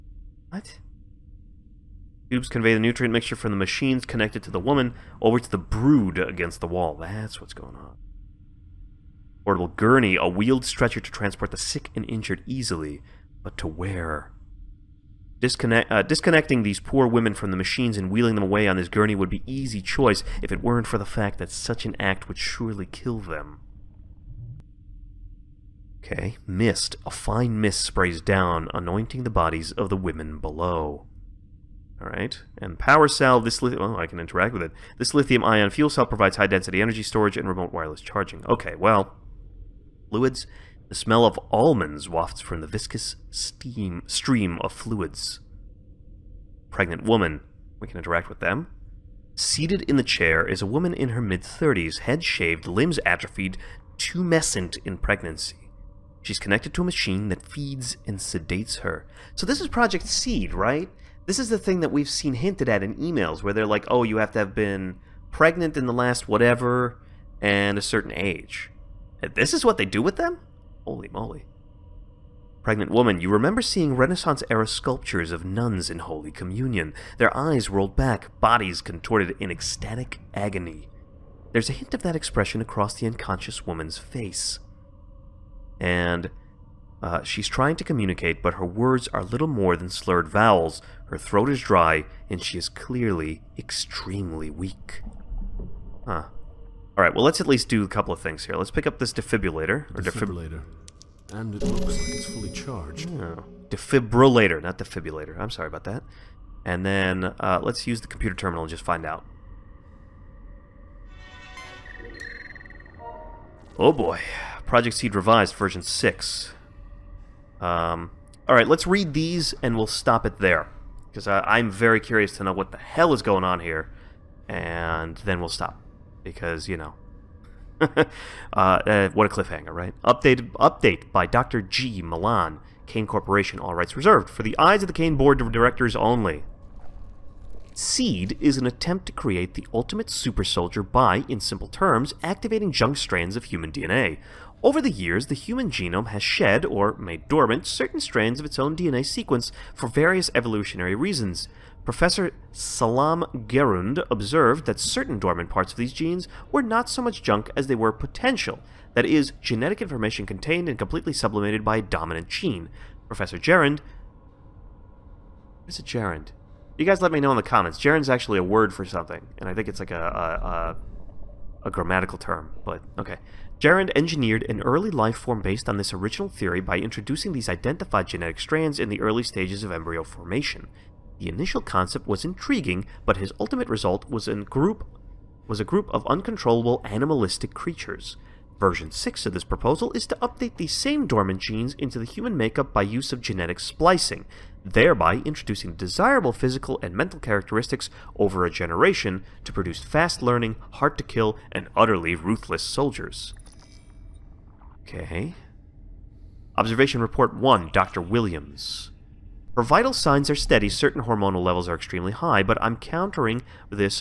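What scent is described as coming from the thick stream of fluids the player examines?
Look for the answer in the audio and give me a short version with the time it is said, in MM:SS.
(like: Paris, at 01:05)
Almonds, at 00:41.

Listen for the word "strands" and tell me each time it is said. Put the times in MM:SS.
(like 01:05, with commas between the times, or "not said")
02:22, 02:27, 02:58.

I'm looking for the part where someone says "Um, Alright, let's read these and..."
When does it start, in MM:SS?
01:57.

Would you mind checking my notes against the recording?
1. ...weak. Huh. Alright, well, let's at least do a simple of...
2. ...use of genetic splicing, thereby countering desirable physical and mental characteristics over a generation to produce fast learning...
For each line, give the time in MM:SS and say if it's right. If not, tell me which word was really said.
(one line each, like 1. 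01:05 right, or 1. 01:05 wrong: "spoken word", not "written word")
1. 01:34 wrong: "couple", not "simple"
2. 03:12 wrong: "introducing", not "countering".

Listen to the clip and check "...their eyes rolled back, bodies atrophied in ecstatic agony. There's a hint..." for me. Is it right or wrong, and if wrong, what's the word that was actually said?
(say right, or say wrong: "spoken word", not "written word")
wrong: "contorted", not "atrophied".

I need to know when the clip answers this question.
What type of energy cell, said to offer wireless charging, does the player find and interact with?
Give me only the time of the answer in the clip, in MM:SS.
00:35.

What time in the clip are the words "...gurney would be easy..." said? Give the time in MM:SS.
00:18.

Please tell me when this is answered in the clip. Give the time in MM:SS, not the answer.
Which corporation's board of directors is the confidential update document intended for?
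02:12.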